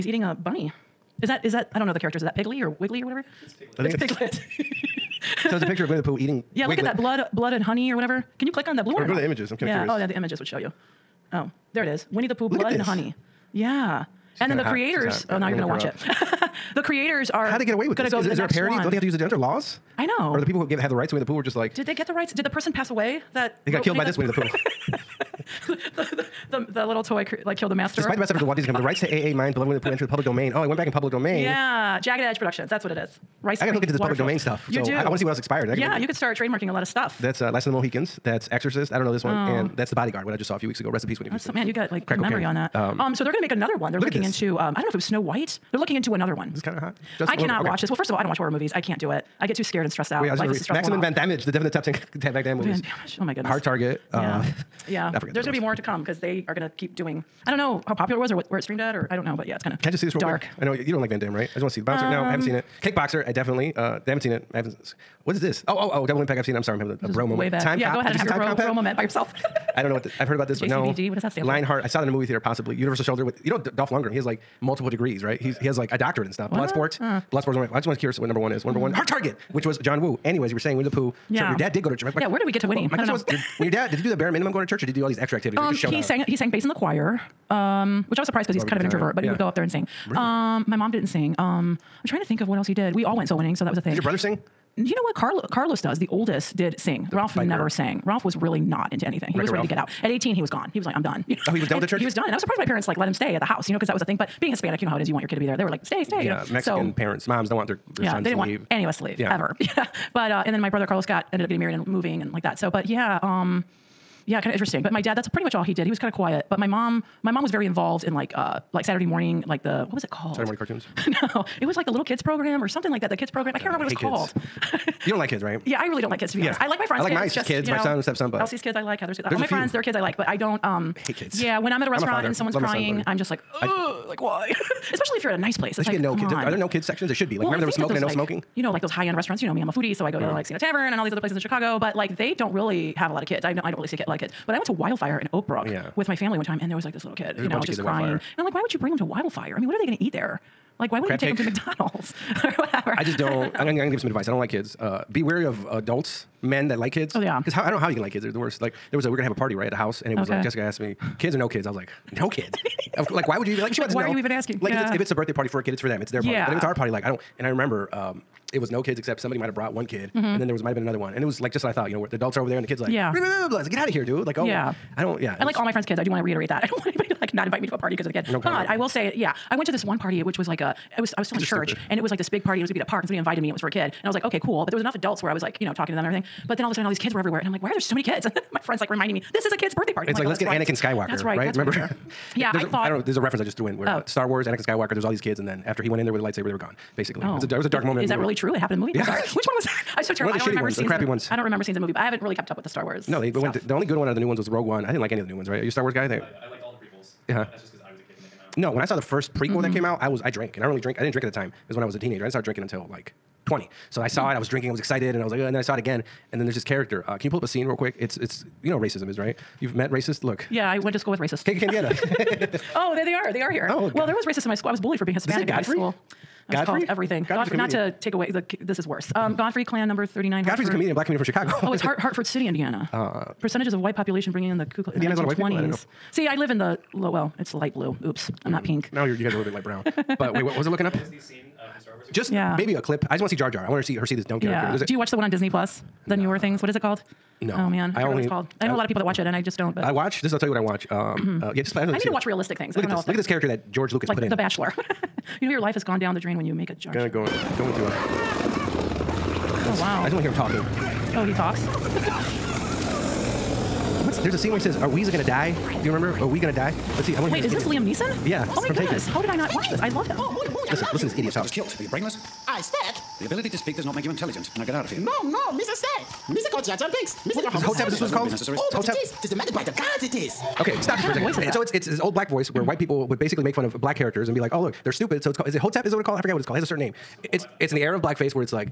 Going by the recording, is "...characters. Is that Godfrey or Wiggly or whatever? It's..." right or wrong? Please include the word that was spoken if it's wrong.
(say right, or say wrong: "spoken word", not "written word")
wrong: "Piggly", not "Godfrey".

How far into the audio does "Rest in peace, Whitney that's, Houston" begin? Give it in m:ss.
0:40.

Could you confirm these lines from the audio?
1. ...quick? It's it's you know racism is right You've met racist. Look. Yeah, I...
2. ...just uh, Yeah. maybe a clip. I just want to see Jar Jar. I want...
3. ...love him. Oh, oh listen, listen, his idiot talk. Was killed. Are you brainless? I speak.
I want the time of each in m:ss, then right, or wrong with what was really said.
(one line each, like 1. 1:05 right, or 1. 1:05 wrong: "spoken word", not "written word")
1. 3:37 right
2. 4:02 right
3. 4:29 right.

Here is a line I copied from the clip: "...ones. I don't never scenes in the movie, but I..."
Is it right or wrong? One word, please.
wrong.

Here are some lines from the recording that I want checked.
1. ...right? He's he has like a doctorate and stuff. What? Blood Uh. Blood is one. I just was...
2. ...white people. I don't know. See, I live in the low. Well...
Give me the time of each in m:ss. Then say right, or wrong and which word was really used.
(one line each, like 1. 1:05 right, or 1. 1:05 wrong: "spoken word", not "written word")
1. 1:15 right
2. 3:55 right.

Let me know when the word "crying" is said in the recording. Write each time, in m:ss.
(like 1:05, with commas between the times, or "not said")
2:12, 2:27.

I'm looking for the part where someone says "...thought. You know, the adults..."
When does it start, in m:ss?
2:51.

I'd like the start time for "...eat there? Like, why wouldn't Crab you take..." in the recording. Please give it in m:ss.
2:30.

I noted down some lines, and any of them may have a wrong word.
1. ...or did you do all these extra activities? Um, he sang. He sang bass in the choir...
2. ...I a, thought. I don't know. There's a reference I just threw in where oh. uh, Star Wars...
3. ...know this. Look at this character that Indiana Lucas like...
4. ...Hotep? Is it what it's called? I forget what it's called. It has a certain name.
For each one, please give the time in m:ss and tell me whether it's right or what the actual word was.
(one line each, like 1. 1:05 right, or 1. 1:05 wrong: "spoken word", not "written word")
1. 1:24 right
2. 3:12 right
3. 4:12 wrong: "George", not "Indiana"
4. 4:45 right.